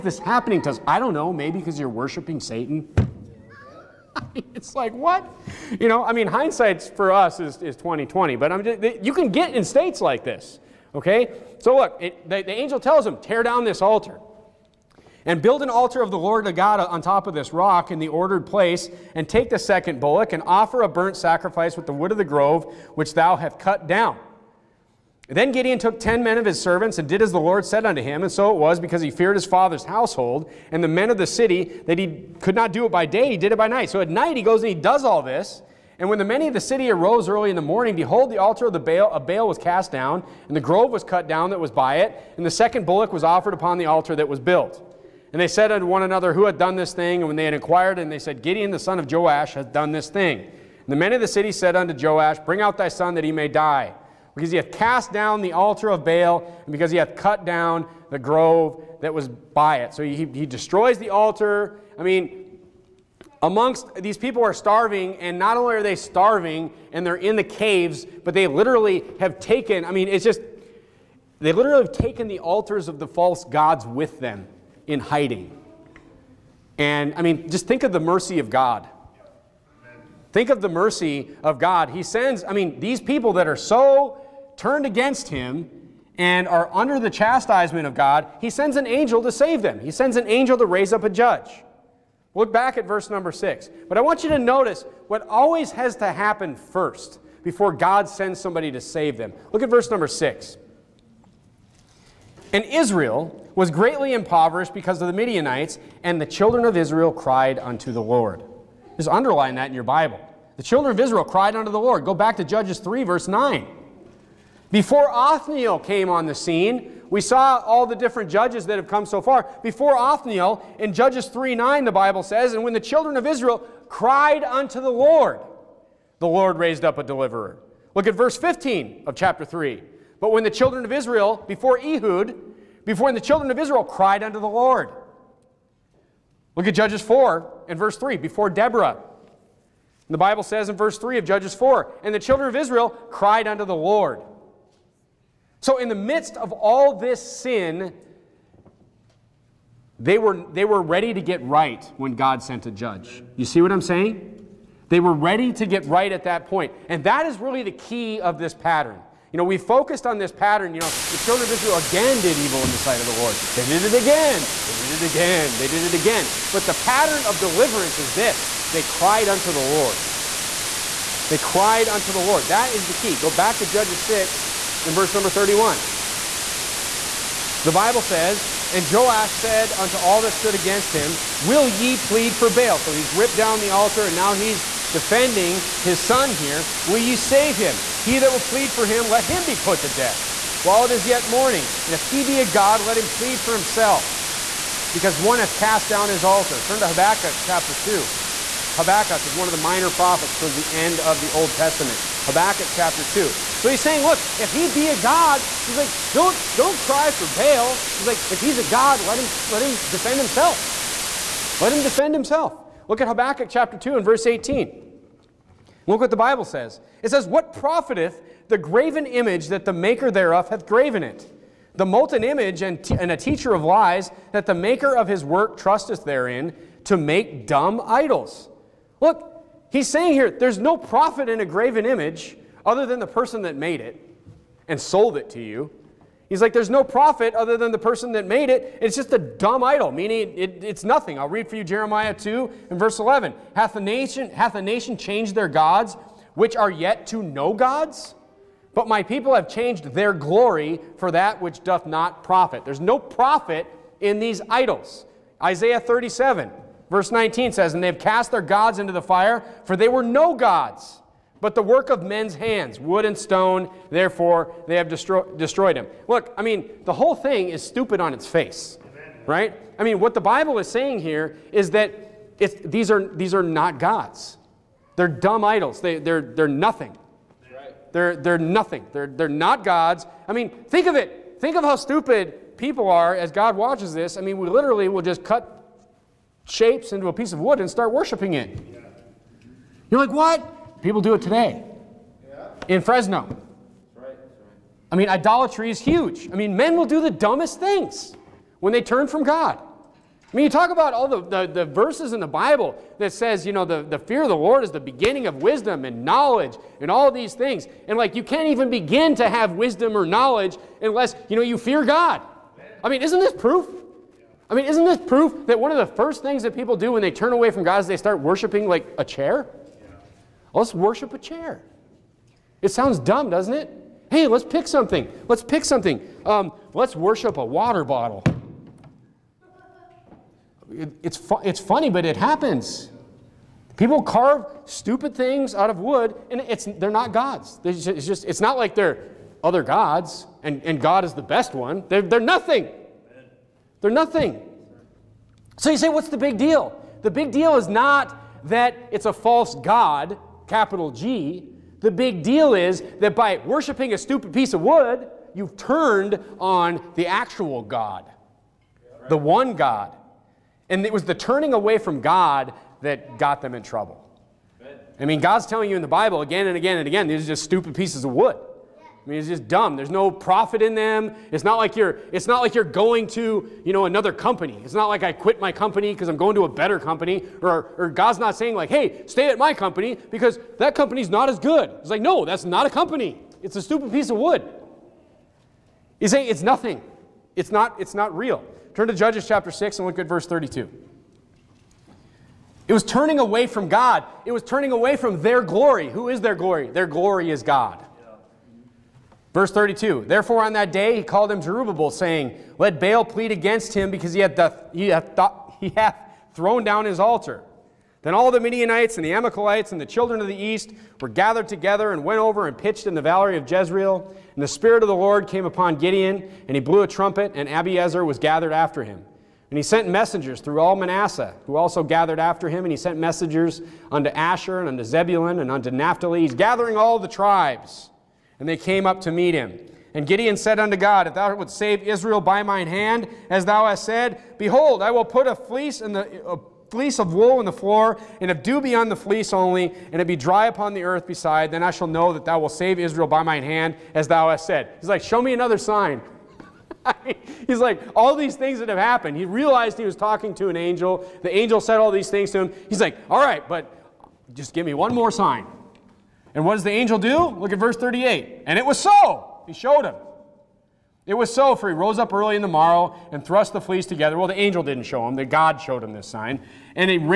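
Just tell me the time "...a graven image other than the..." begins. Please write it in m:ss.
3:51.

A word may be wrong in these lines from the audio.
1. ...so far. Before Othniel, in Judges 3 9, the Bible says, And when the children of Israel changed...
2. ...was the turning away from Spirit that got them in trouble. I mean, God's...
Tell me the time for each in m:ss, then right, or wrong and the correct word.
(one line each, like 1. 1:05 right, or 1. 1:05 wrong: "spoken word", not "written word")
1. 1:59 wrong: "cried", not "changed"
2. 6:00 wrong: "God", not "Spirit".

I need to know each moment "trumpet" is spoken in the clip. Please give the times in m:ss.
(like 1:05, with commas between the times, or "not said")
6:56.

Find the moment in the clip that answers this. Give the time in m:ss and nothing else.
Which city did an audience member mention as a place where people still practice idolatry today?
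4:52.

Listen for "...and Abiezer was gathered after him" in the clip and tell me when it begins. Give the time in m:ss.
6:57.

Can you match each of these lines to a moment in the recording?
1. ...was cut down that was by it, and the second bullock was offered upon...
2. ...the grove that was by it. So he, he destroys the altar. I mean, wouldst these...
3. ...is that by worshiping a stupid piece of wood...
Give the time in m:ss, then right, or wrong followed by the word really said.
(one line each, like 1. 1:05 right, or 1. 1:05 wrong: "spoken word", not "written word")
1. 0:40 right
2. 0:58 wrong: "amongst", not "wouldst"
3. 5:52 right.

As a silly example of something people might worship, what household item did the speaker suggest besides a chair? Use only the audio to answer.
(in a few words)
A water bottle.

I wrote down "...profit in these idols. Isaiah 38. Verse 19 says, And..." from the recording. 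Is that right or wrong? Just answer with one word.
wrong.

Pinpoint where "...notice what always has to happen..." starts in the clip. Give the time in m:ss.
1:34.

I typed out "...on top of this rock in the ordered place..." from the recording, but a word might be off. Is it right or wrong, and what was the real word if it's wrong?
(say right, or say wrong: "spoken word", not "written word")
right.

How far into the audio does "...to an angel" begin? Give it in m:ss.
7:30.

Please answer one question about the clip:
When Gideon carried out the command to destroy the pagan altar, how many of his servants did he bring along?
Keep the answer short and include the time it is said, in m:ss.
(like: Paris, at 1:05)
10, at 0:25.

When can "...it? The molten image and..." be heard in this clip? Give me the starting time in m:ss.
3:41.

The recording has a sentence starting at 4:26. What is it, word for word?
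Look, I mean, the whole thing is stupid on its face, right?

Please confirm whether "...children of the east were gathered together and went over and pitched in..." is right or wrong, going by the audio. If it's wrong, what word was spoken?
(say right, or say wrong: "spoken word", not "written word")
right.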